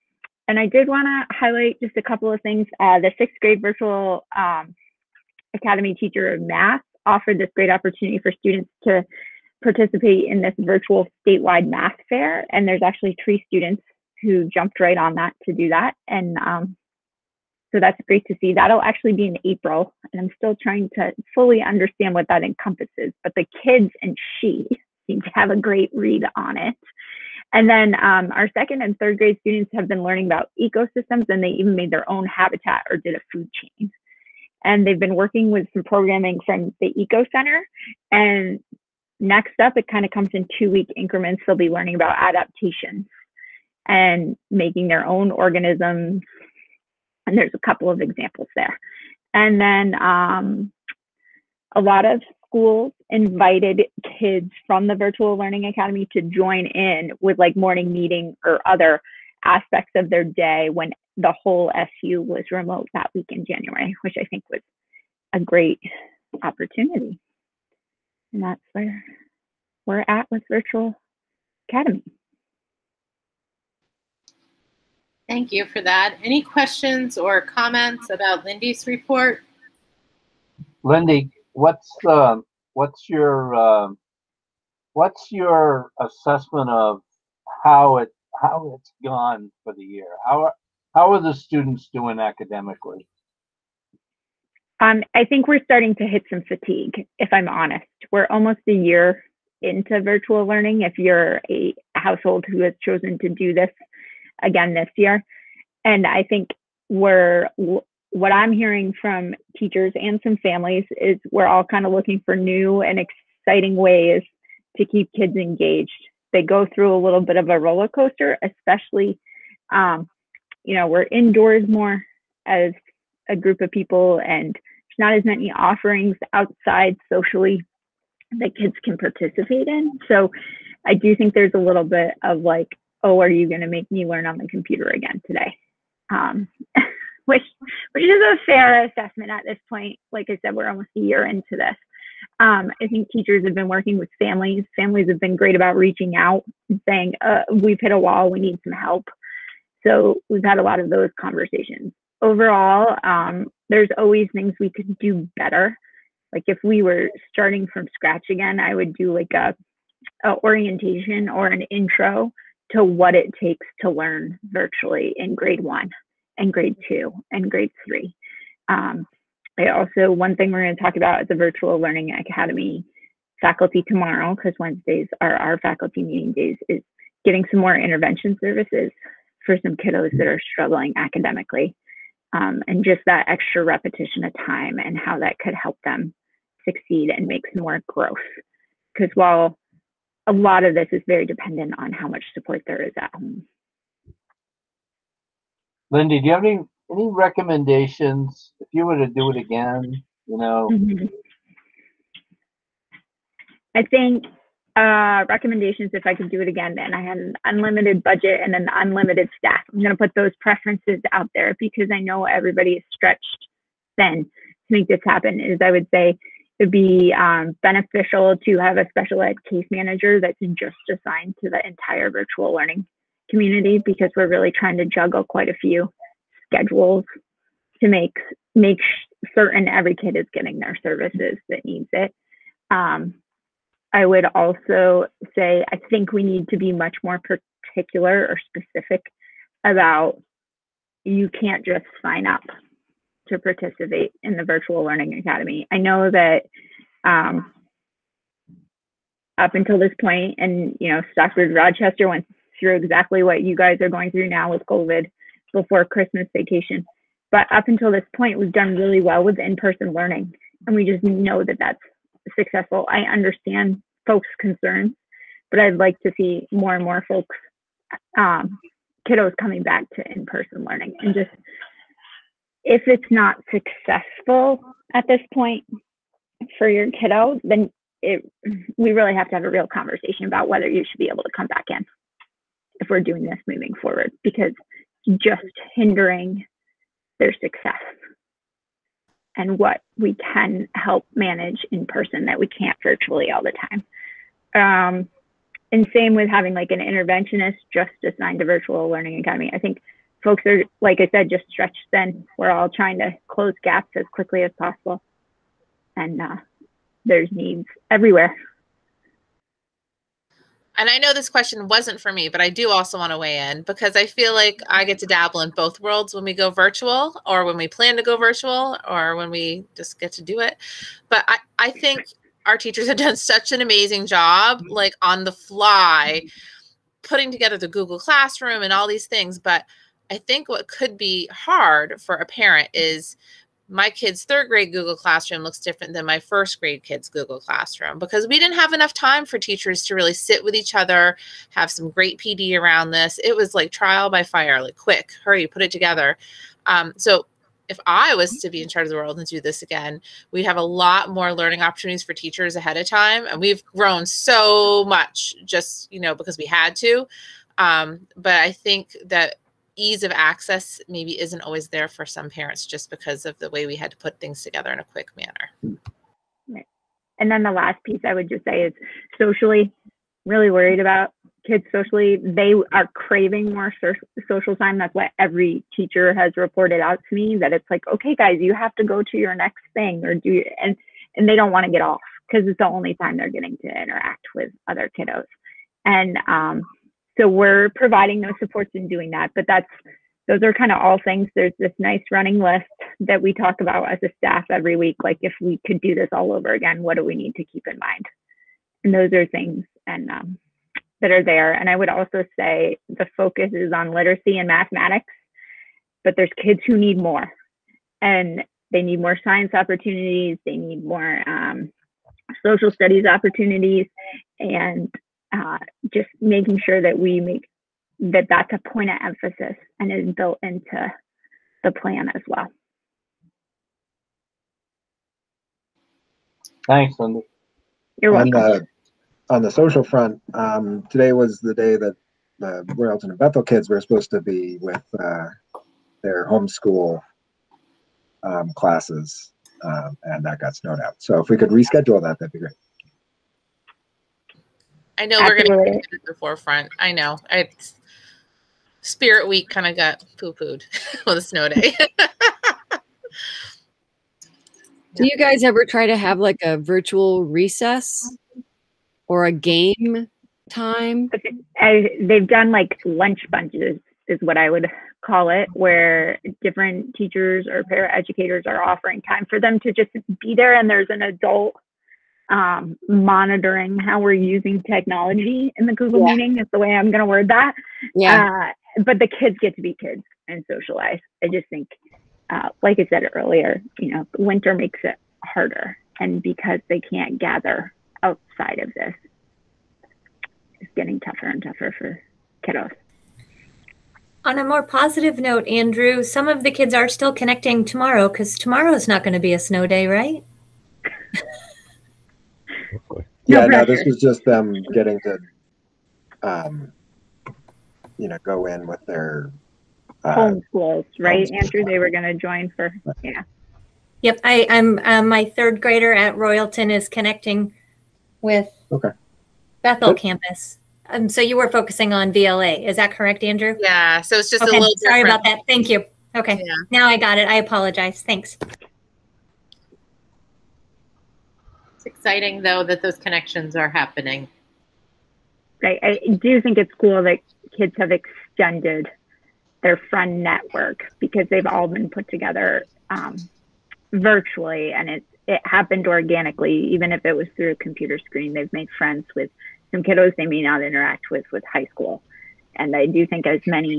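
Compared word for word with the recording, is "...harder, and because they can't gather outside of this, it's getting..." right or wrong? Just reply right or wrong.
right.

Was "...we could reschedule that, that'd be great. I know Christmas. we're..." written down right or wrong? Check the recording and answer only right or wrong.
wrong.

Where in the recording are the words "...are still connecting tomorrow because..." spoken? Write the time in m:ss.
8:16.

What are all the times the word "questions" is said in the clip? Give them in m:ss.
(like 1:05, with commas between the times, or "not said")
1:16, 5:11.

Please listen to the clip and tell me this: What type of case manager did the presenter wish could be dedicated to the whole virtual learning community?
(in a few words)
Special ed.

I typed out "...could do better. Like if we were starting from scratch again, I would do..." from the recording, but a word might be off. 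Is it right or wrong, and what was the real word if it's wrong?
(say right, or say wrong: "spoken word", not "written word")
right.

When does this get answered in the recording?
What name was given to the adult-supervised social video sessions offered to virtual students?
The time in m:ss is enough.
7:42.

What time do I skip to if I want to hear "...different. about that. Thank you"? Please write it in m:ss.
8:45.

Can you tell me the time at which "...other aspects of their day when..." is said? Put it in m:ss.
0:58.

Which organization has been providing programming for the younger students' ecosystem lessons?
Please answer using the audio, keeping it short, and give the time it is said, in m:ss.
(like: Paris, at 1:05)
Eco Center, at 0:36.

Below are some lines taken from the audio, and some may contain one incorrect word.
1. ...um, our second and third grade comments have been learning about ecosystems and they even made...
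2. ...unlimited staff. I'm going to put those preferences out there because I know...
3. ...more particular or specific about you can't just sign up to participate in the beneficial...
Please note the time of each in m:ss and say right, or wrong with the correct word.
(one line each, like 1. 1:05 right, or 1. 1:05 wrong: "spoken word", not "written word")
1. 0:28 wrong: "students", not "comments"
2. 3:28 right
3. 3:57 wrong: "virtual", not "beneficial".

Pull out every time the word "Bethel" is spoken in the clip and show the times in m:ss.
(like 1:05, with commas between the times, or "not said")
7:13, 8:39.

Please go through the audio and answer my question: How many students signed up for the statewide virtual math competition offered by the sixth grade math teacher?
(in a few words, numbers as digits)
3.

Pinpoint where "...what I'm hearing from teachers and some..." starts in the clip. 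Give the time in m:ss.
1:48.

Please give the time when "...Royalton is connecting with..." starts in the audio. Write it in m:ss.
8:36.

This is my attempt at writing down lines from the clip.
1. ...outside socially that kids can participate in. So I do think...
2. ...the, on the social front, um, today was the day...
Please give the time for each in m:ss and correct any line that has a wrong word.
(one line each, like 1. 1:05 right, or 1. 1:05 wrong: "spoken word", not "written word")
1. 2:06 right
2. 7:08 right.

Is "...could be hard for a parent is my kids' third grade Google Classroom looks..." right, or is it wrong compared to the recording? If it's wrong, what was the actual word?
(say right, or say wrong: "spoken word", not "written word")
right.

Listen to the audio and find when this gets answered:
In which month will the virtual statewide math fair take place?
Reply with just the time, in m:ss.
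0:19.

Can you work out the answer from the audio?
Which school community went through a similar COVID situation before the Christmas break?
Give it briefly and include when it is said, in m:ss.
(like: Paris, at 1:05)
Stockbridge Rochester, at 4:11.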